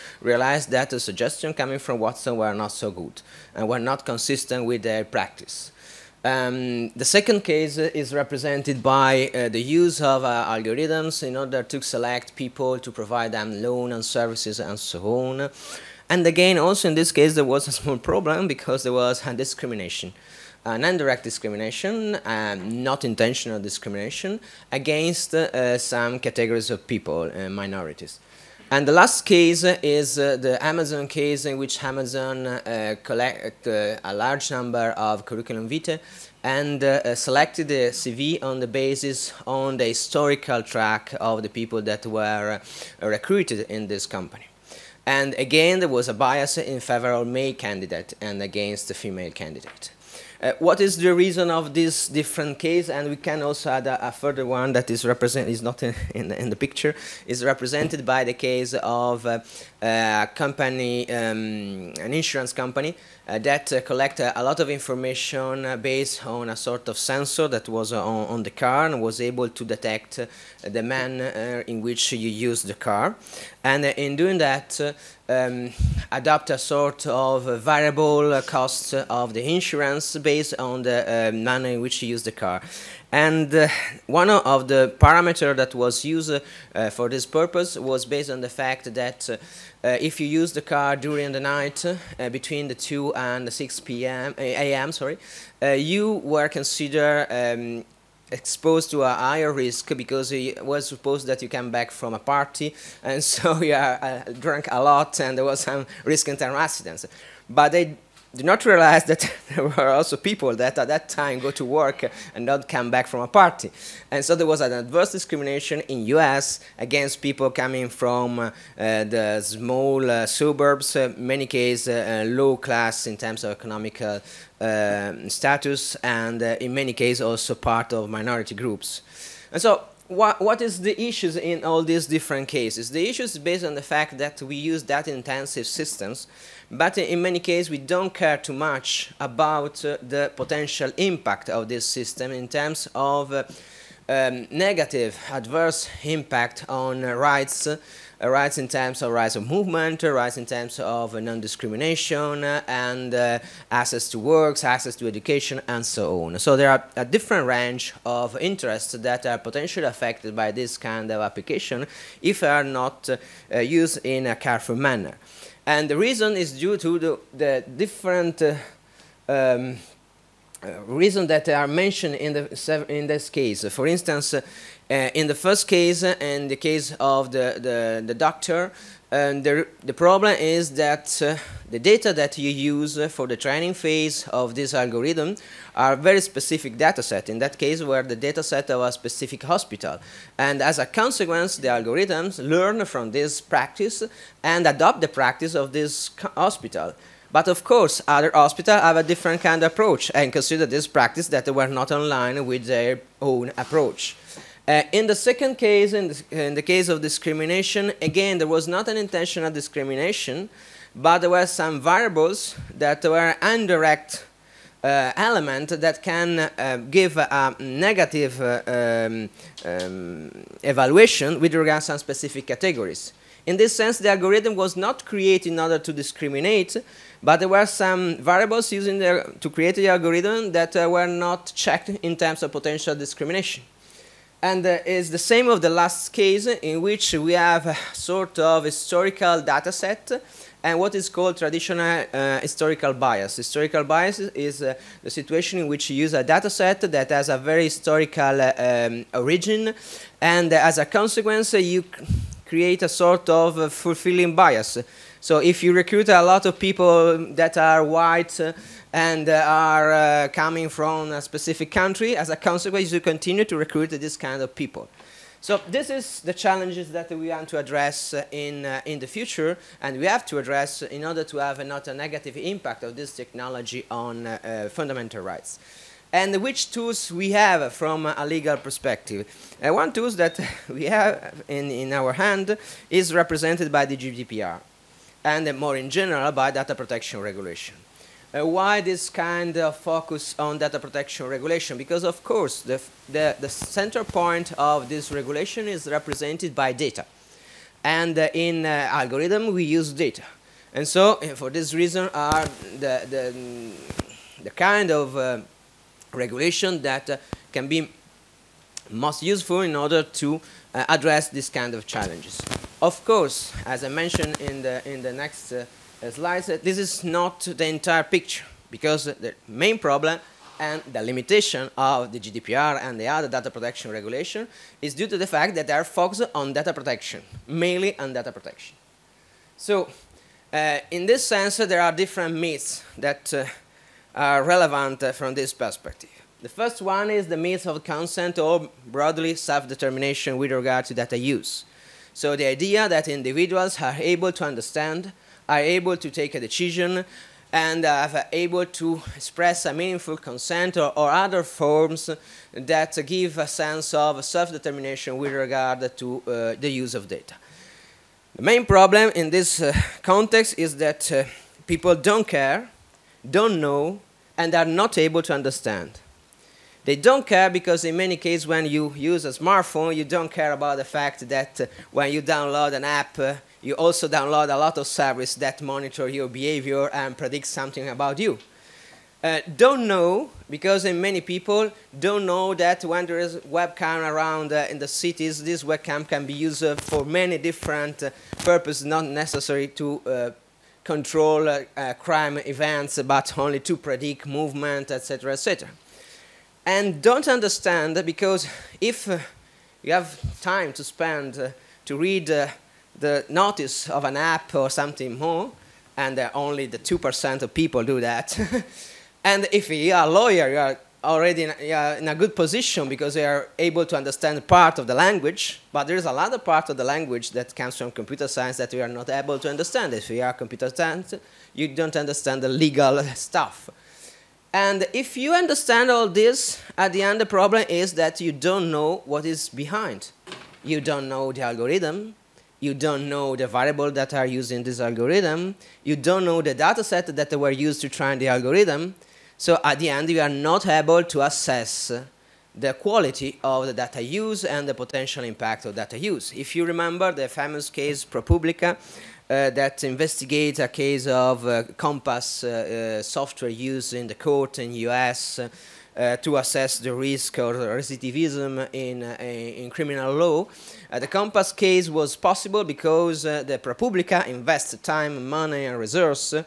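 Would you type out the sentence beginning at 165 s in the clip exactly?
And the reason is due to the, the different um, uh, reasons that are mentioned in, the, in this case.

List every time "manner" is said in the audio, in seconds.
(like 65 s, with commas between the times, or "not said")
70 s, 81 s, 164 s.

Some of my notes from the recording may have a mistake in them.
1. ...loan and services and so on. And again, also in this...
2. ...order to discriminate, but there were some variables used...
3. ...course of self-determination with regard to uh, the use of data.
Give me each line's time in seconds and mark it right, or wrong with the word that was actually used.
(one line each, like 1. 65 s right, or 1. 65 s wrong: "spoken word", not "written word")
1. 13 s right
2. 225 s right
3. 353 s wrong: "sense", not "course".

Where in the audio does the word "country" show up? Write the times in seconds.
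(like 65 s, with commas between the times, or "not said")
261 s.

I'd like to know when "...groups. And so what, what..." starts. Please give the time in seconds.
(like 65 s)
128 s.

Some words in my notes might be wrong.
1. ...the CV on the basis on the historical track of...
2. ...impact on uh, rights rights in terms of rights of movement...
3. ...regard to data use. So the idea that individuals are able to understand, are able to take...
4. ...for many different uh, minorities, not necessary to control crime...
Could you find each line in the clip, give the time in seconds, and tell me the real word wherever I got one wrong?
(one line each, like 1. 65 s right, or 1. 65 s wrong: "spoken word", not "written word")
1. 37 s right
2. 146 s right
3. 340 s right
4. 386 s wrong: "purposes", not "minorities".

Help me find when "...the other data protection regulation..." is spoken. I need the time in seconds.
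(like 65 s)
322 s.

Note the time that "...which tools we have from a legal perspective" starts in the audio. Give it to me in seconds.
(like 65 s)
276 s.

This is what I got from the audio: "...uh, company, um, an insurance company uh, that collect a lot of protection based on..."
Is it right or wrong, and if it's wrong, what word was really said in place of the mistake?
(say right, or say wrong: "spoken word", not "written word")
wrong: "information", not "protection".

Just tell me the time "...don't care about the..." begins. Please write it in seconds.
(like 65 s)
370 s.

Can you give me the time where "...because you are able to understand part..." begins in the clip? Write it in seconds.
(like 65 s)
412 s.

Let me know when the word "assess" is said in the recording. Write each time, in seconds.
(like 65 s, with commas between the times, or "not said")
441 s, 456 s.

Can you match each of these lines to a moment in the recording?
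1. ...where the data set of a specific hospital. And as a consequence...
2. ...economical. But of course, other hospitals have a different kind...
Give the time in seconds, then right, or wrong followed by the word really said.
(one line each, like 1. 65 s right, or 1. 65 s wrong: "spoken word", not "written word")
1. 187 s right
2. 196 s wrong: "hospital", not "economical".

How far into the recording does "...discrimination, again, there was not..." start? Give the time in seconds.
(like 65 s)
207 s.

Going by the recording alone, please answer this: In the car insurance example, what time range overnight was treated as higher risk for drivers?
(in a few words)
2 to 6 a.m.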